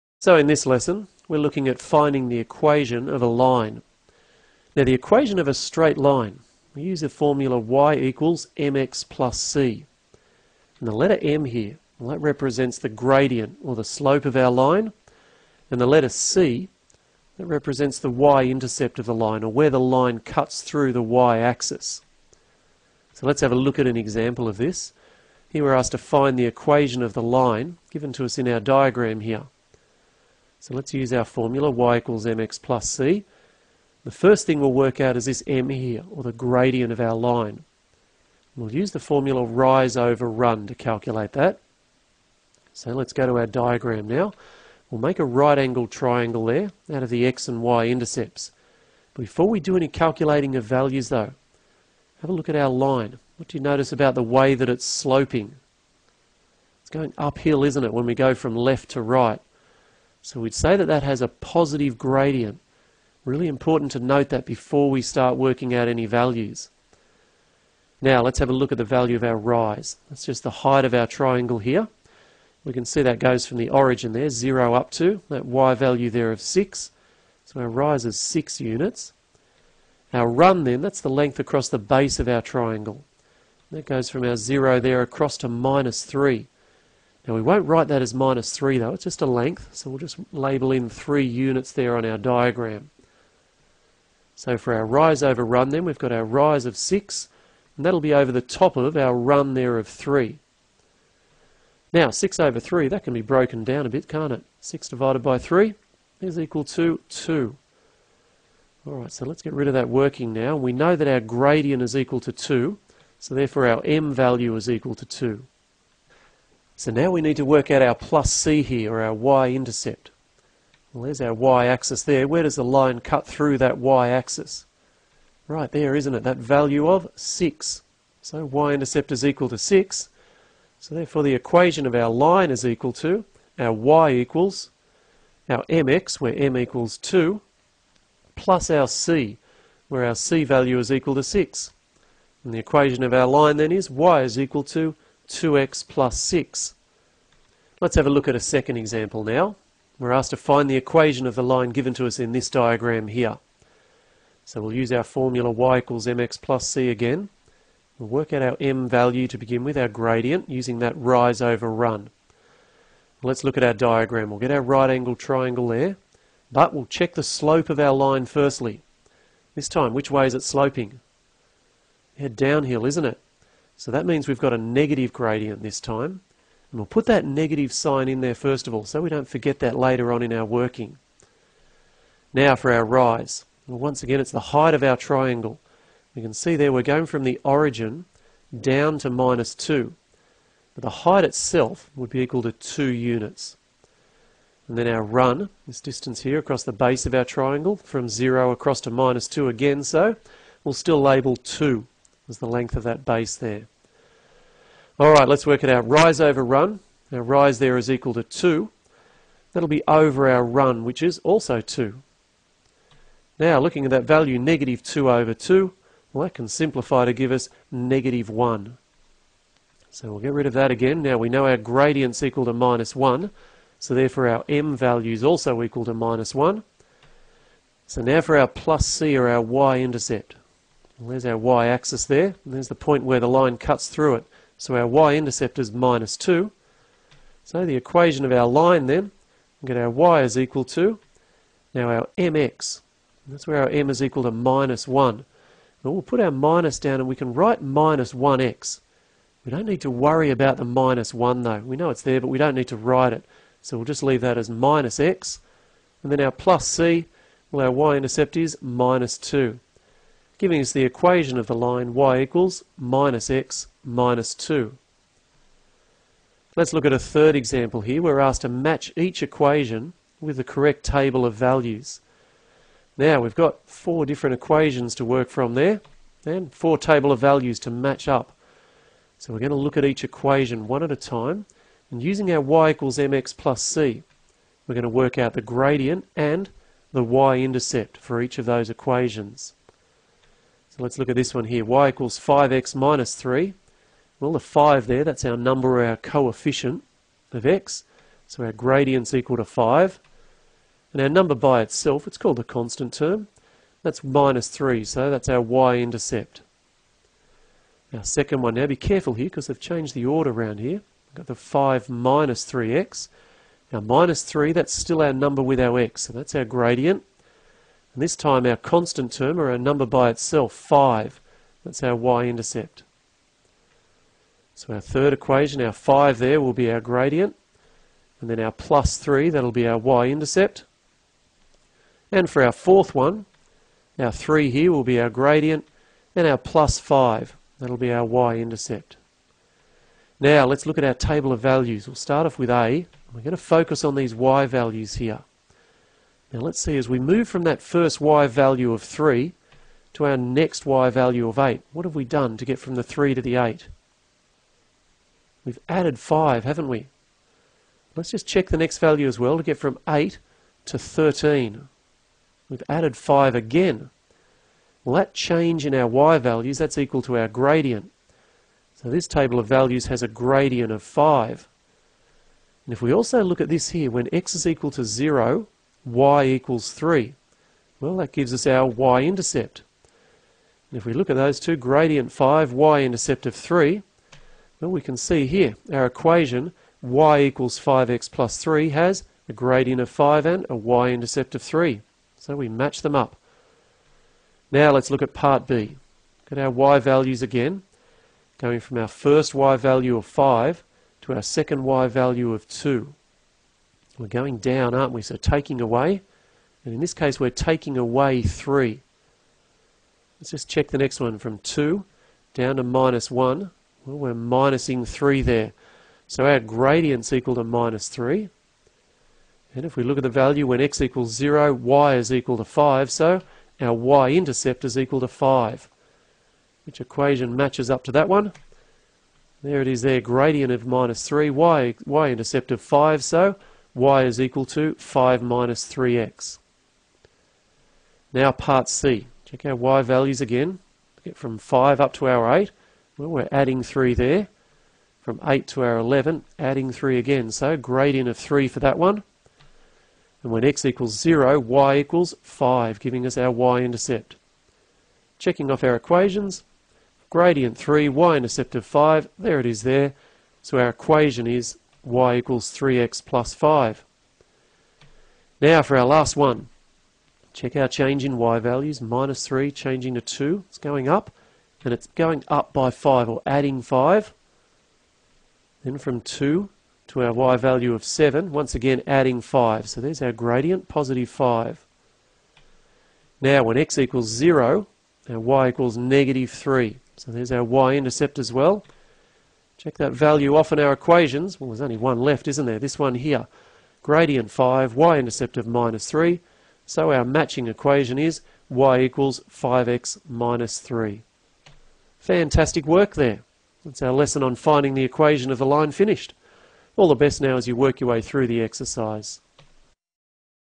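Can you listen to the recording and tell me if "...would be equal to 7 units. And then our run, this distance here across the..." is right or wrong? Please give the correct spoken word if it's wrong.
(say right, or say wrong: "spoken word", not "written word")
wrong: "2", not "7".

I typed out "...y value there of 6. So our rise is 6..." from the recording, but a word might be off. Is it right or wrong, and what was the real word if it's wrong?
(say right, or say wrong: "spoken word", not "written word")
right.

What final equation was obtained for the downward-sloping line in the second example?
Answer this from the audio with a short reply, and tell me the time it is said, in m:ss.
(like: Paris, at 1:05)
y = -x - 2, at 4:21.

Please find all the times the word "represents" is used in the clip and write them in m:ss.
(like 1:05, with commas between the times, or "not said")
0:12, 0:17.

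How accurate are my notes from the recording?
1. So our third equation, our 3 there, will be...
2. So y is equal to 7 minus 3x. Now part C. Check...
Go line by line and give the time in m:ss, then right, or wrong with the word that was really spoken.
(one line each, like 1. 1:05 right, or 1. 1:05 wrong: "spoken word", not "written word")
1. 5:24 wrong: "5", not "3"
2. 7:13 wrong: "5", not "7".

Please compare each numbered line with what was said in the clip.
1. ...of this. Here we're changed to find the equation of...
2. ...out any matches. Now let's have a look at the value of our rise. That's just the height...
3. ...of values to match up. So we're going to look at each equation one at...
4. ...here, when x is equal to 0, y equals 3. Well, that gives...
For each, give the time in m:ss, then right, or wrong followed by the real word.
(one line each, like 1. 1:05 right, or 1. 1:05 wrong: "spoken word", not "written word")
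1. 0:24 wrong: "asked", not "changed"
2. 1:05 wrong: "values", not "matches"
3. 4:37 right
4. 6:13 right.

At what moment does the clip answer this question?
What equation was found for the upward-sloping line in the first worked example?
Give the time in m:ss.
2:23.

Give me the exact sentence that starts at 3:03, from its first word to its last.
Well, once again, it's the height of our triangle.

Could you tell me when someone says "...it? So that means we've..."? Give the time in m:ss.
2:53.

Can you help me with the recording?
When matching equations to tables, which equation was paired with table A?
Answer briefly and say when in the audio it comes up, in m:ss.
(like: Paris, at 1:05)
y = 5x + 3, at 6:26.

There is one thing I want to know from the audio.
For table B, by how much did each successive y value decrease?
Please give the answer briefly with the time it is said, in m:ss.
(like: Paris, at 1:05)
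3, at 6:47.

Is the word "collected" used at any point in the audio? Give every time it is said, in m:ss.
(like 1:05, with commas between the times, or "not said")
not said.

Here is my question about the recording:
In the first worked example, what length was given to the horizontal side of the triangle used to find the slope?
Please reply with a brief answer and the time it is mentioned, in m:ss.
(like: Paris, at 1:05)
3 units, at 1:30.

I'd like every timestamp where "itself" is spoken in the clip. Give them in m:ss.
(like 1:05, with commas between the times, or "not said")
3:11, 5:01, 5:20.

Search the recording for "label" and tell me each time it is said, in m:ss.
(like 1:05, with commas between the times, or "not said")
1:30, 3:21.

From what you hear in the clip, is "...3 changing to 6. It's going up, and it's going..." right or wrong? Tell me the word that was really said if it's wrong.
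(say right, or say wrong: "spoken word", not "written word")
wrong: "2", not "6".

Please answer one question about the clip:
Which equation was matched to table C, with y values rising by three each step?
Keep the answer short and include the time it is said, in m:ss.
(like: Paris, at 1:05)
y = 3x + 5, at 7:41.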